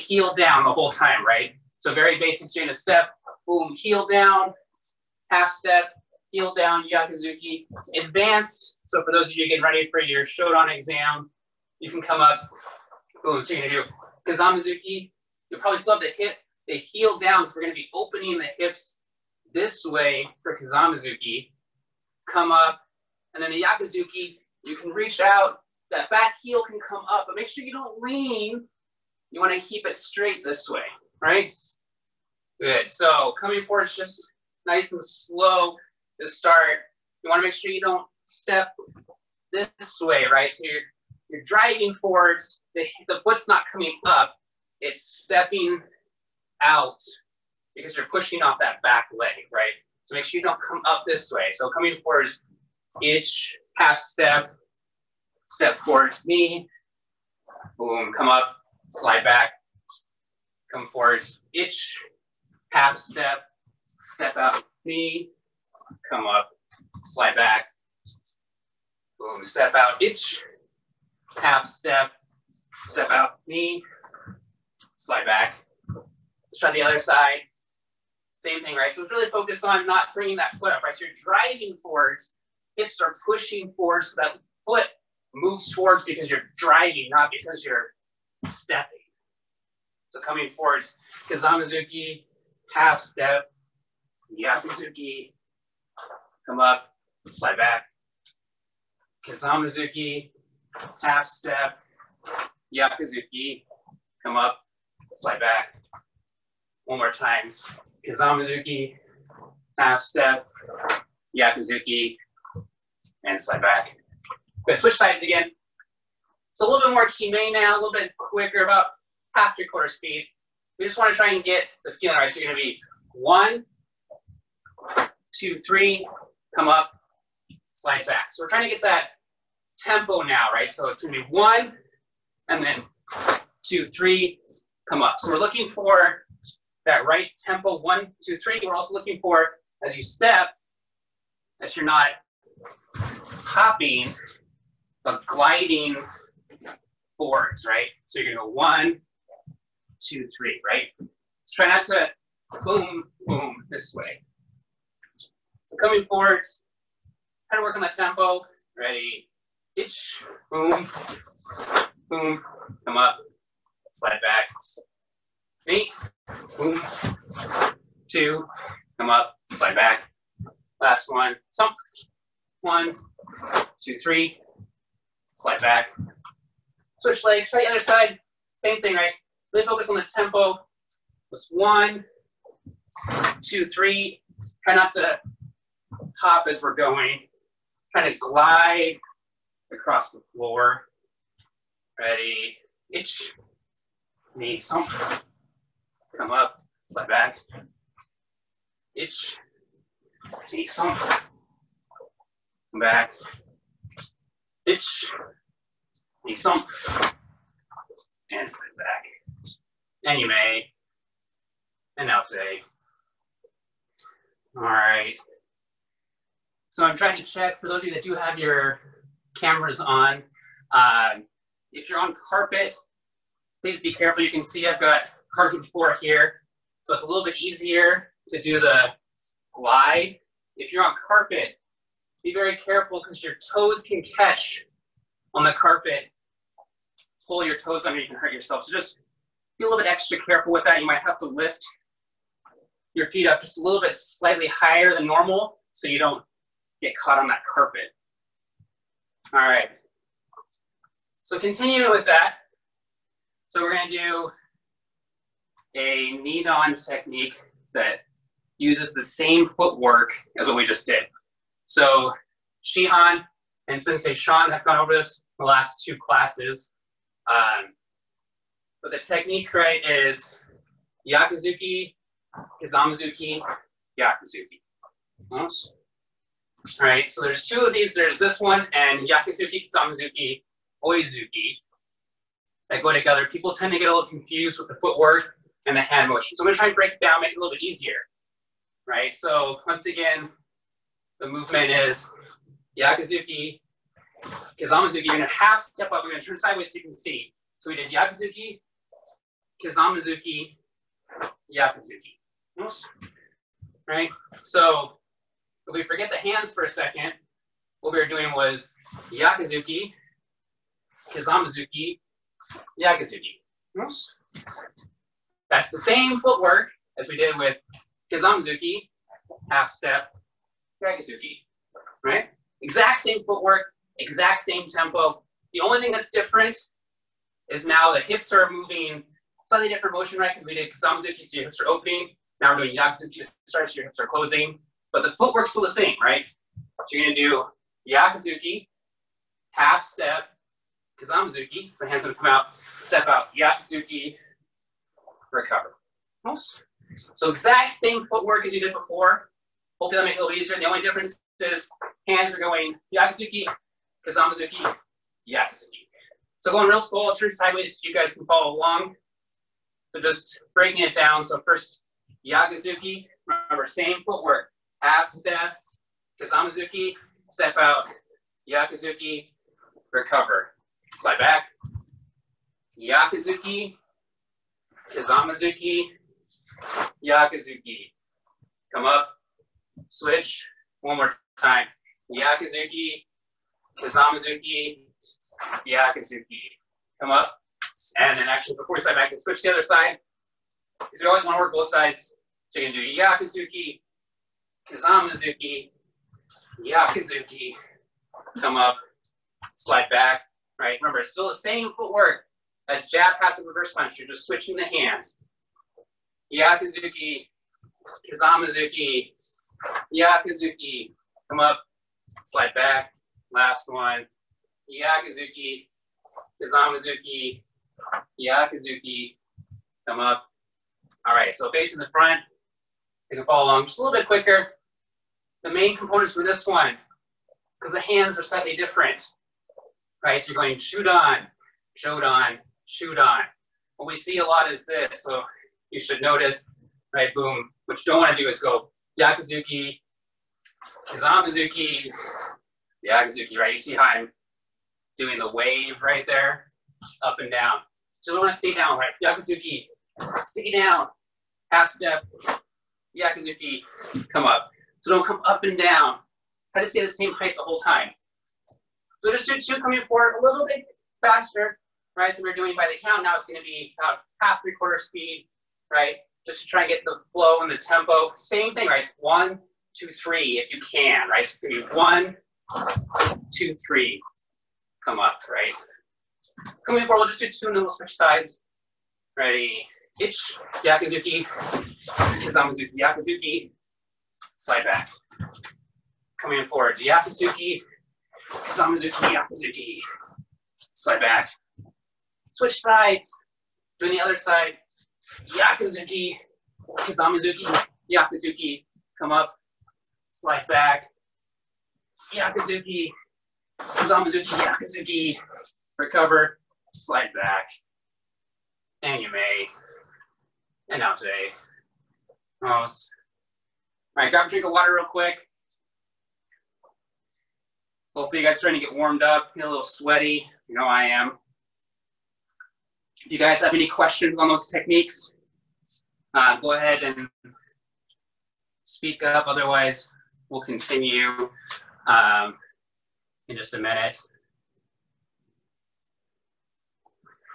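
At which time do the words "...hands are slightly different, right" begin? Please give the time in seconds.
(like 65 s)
427 s.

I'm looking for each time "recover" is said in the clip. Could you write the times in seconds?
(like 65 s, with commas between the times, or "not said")
345 s, 369 s, 505 s.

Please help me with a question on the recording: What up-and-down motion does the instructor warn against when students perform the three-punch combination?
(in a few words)
The wave.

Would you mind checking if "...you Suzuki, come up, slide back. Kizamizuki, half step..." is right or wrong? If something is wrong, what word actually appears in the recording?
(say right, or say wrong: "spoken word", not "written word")
right.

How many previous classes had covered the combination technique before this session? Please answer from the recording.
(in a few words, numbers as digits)
2.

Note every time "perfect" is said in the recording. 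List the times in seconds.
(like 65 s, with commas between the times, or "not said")
not said.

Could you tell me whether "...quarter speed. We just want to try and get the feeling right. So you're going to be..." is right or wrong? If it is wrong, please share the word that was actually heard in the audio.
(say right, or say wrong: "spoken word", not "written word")
right.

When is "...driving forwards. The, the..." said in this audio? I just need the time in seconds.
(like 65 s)
41 s.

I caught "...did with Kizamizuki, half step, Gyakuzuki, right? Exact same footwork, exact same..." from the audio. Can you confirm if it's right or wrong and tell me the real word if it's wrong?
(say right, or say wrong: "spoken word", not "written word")
right.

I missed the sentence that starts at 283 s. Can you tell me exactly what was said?
People tend to get a little confused with the footwork and the hand motion.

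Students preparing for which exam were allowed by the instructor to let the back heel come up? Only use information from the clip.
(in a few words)
Shodan.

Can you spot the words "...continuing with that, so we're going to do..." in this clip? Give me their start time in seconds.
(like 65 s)
251 s.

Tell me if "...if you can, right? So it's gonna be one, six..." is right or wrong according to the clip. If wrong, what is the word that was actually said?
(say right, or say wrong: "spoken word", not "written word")
wrong: "two", not "six".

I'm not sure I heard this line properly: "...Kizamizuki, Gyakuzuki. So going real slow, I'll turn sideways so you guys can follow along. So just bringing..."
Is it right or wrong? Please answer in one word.
wrong.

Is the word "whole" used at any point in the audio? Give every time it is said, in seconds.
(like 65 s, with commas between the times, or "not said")
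0 s, 457 s.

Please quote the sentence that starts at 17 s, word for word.
So we're gonna be opening the hips this way for Kizamizuki.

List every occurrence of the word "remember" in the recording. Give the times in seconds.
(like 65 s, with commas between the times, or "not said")
363 s, 400 s.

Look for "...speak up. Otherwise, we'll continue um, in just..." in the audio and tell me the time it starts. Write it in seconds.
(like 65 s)
528 s.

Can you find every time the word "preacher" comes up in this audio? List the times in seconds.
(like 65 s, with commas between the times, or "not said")
not said.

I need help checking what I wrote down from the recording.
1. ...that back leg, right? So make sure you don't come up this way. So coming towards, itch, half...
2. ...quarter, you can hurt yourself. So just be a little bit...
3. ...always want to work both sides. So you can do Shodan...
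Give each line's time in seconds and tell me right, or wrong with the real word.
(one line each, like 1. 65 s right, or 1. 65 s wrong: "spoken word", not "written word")
1. 48 s wrong: "forwards", not "towards"
2. 237 s wrong: "under", not "quarter"
3. 391 s wrong: "Gyakuzuki", not "Shodan".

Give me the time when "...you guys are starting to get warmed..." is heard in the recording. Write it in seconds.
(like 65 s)
518 s.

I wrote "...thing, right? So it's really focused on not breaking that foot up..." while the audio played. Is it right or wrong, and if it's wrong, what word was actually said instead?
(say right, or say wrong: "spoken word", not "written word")
wrong: "bringing", not "breaking".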